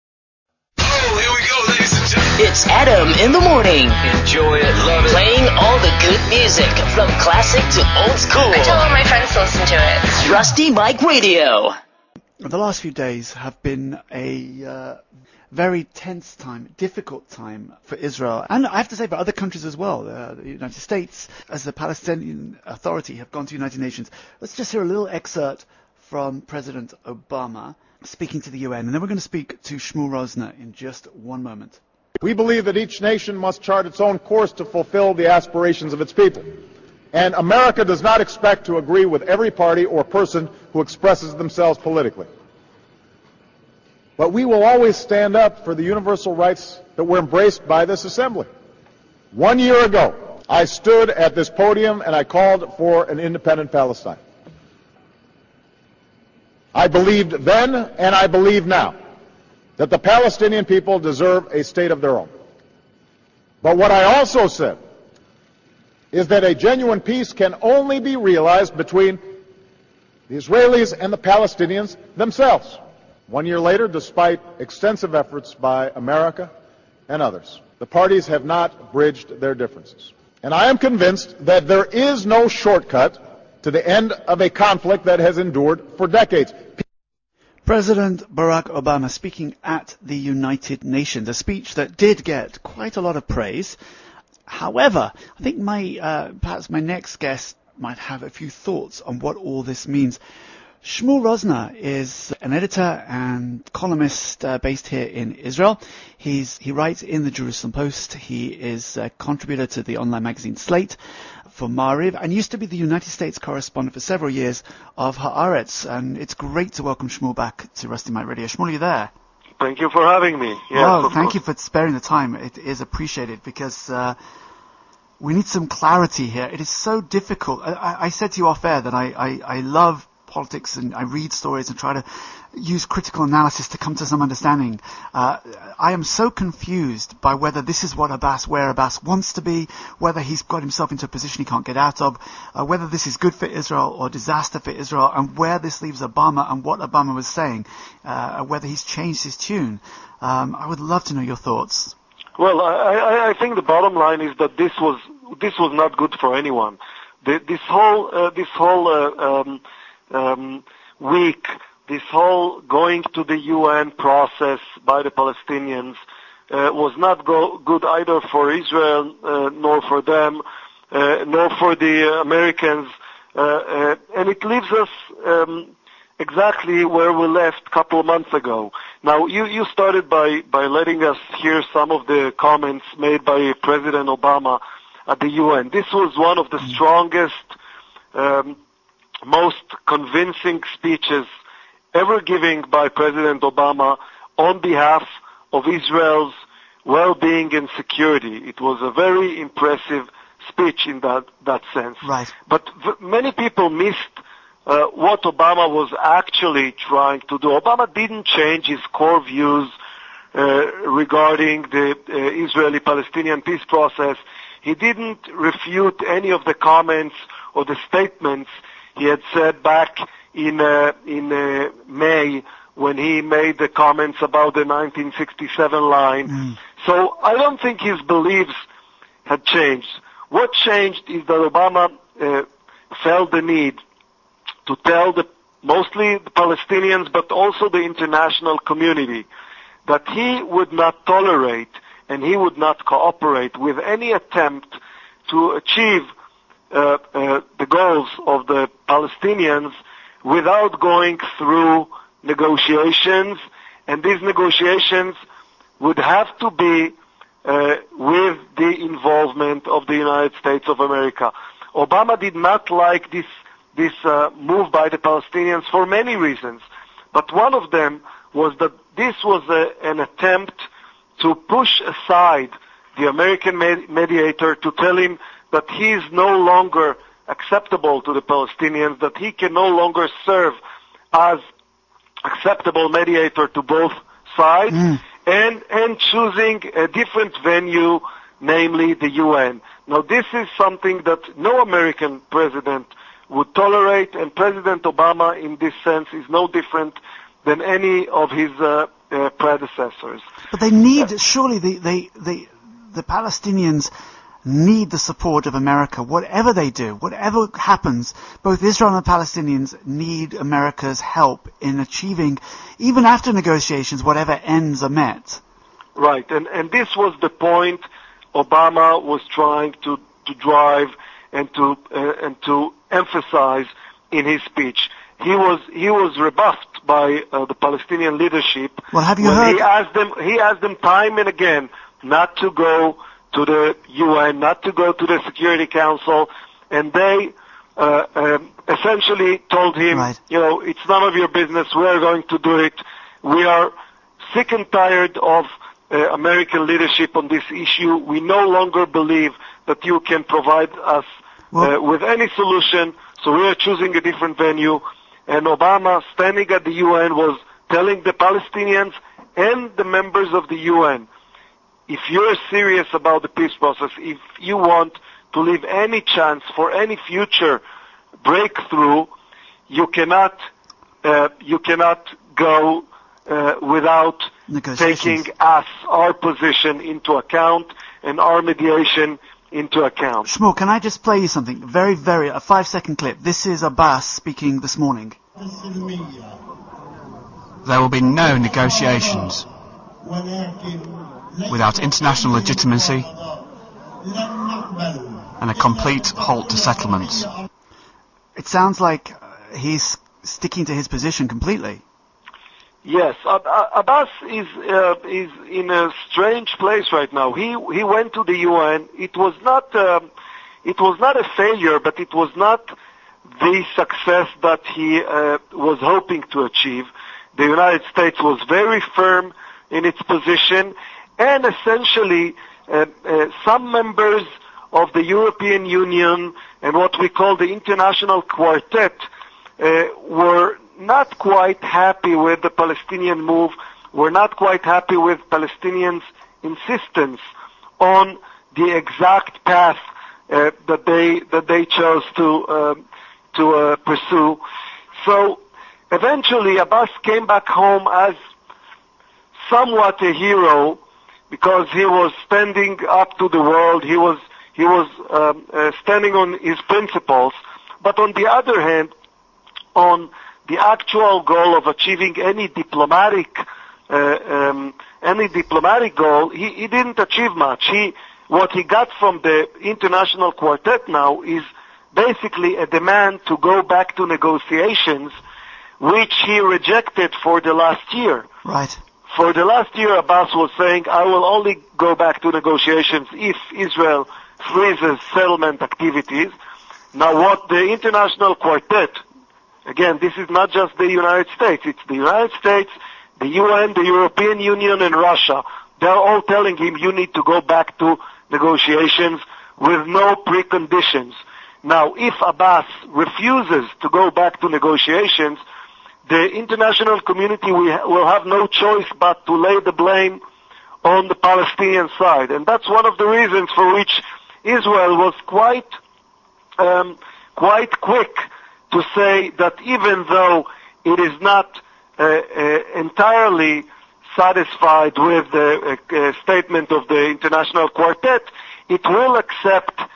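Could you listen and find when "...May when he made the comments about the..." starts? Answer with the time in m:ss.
3:41.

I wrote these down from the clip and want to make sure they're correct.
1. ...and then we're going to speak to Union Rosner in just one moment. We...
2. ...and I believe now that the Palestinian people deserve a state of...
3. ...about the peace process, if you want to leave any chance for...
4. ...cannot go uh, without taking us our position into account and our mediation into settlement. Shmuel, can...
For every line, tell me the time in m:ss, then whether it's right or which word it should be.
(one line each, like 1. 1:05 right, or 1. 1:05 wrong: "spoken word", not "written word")
1. 0:28 wrong: "Shmuel", not "Union"
2. 0:57 right
3. 6:02 right
4. 6:11 wrong: "account", not "settlement".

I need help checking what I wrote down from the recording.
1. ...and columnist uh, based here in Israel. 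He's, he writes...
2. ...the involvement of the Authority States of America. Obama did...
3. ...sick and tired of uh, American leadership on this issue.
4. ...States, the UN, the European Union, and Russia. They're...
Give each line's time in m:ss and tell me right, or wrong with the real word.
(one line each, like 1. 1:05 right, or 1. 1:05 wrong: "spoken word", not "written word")
1. 1:43 right
2. 4:18 wrong: "United", not "Authority"
3. 5:44 right
4. 8:12 right.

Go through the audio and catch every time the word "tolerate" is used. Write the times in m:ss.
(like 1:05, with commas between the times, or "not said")
4:01, 4:53.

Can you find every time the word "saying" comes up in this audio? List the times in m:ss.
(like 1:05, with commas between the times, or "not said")
2:27, 8:00.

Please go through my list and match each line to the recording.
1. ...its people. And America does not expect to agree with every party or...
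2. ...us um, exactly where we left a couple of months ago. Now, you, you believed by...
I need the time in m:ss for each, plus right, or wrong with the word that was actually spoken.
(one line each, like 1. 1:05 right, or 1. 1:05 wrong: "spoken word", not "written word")
1. 0:36 right
2. 2:54 wrong: "started", not "believed".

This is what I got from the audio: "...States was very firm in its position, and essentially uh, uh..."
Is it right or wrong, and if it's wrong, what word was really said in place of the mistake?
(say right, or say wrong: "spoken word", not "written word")
right.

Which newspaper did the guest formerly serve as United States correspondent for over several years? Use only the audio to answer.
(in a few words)
Haaretz.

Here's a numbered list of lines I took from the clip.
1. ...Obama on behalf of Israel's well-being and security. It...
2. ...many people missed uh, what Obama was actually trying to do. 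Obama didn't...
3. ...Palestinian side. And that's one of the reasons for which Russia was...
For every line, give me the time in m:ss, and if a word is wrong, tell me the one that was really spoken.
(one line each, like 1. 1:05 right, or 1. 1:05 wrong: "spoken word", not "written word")
1. 3:13 right
2. 3:23 right
3. 8:31 wrong: "Israel", not "Russia".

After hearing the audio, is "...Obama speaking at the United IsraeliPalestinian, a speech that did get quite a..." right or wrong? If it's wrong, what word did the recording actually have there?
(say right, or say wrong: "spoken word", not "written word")
wrong: "Nations", not "IsraeliPalestinian".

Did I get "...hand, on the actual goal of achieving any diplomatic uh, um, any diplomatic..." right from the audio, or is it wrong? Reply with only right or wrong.
right.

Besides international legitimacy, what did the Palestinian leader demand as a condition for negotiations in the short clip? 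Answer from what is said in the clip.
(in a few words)
complete halt to settlements.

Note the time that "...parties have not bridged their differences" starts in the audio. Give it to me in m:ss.
1:17.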